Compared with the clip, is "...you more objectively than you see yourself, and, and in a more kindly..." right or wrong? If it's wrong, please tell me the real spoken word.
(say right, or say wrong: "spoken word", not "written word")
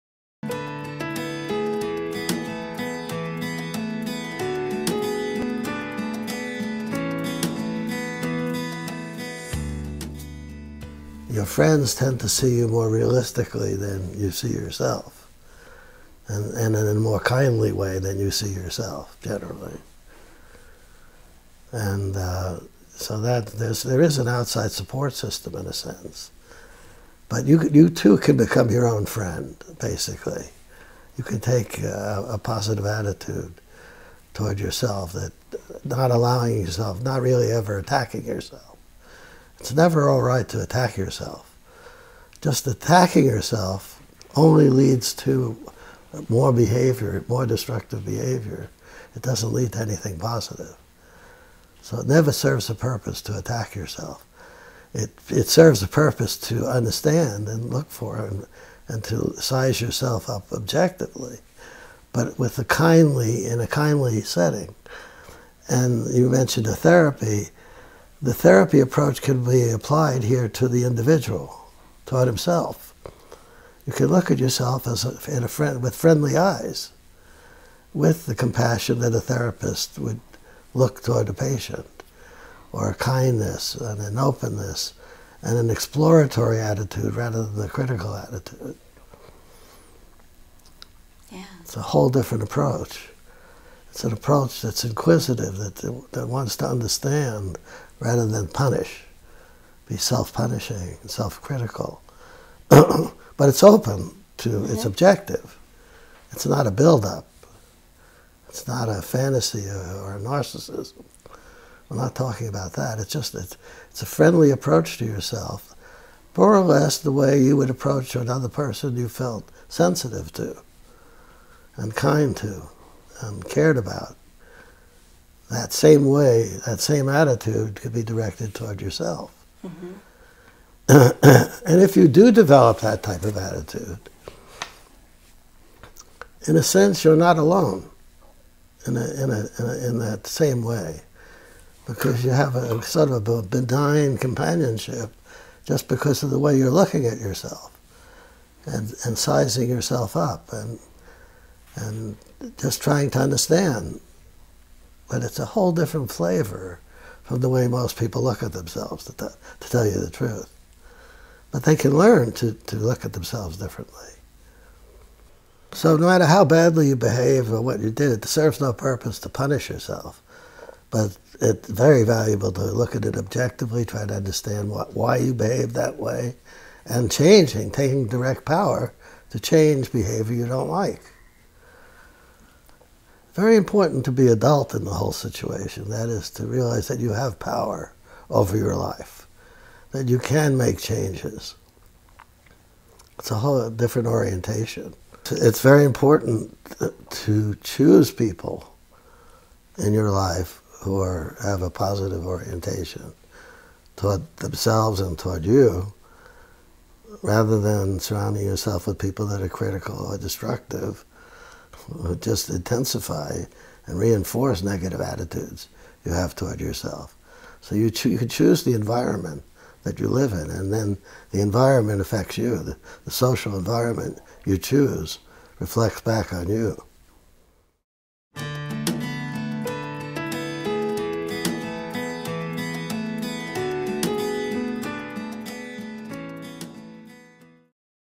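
wrong: "realistically", not "objectively".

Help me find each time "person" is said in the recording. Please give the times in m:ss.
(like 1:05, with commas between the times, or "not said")
1:58.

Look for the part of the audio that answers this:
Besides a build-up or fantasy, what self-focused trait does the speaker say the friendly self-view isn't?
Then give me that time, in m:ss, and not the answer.
1:50.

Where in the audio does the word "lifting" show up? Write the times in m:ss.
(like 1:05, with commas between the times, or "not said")
not said.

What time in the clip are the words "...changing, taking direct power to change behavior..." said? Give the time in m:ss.
2:57.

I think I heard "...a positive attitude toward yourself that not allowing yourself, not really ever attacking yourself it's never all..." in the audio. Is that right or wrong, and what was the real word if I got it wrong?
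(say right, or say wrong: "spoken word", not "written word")
right.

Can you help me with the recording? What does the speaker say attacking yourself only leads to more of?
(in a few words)
Destructive behavior.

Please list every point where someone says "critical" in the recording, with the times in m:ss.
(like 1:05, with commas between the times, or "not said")
1:27, 1:41, 3:29.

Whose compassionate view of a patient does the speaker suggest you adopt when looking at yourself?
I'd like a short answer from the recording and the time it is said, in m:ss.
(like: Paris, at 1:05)
A therapist, at 1:19.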